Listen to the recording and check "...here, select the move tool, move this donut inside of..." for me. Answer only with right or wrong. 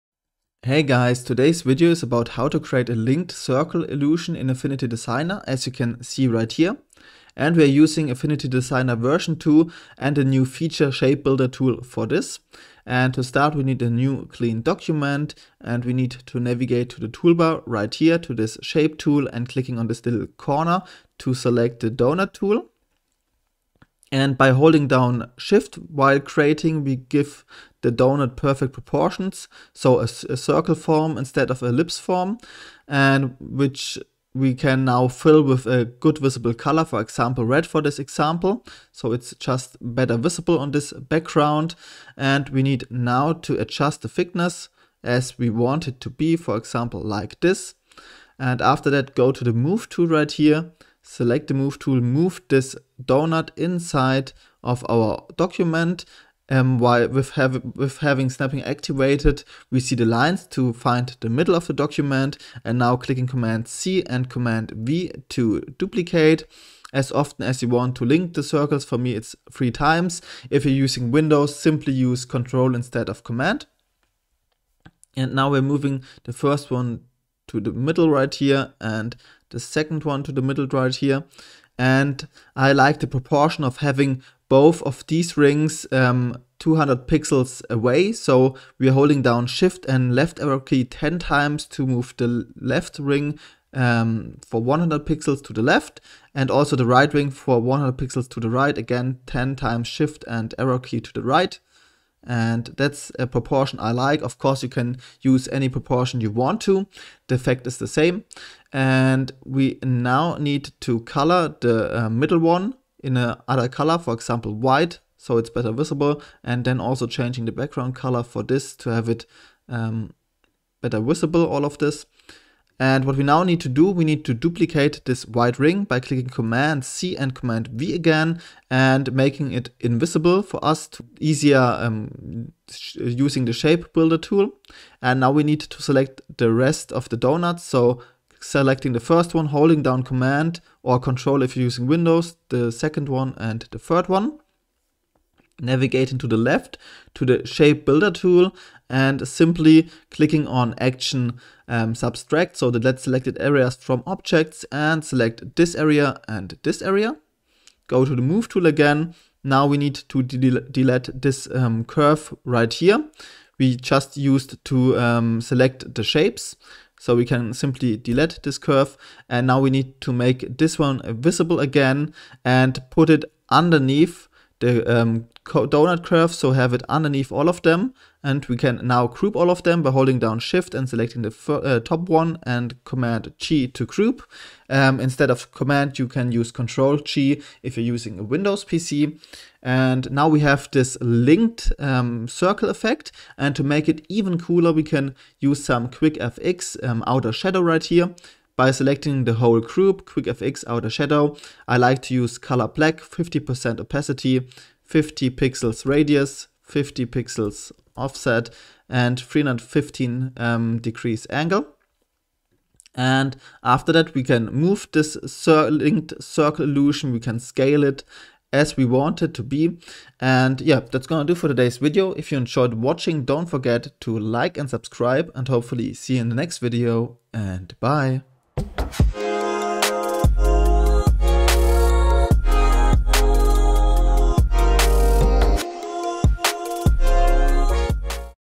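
right.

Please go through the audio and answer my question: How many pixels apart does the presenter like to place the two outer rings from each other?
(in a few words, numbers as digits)
200 pixels.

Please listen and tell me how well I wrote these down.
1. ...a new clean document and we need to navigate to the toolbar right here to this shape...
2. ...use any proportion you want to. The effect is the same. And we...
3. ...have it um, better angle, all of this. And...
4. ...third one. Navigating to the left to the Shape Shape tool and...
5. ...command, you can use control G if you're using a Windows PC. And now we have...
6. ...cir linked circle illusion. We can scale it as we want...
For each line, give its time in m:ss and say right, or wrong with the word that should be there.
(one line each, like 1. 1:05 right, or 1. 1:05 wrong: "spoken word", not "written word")
1. 0:13 right
2. 1:45 right
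3. 1:58 wrong: "visible", not "angle"
4. 2:23 wrong: "Builder", not "Shape"
5. 3:05 right
6. 3:35 right.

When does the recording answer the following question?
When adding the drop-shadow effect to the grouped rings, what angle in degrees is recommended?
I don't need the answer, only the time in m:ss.
3:29.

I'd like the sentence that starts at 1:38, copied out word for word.
Again, 10 times shift and arrow key to the right.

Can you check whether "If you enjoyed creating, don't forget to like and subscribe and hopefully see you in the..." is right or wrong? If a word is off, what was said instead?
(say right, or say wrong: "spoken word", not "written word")
wrong: "watching", not "creating".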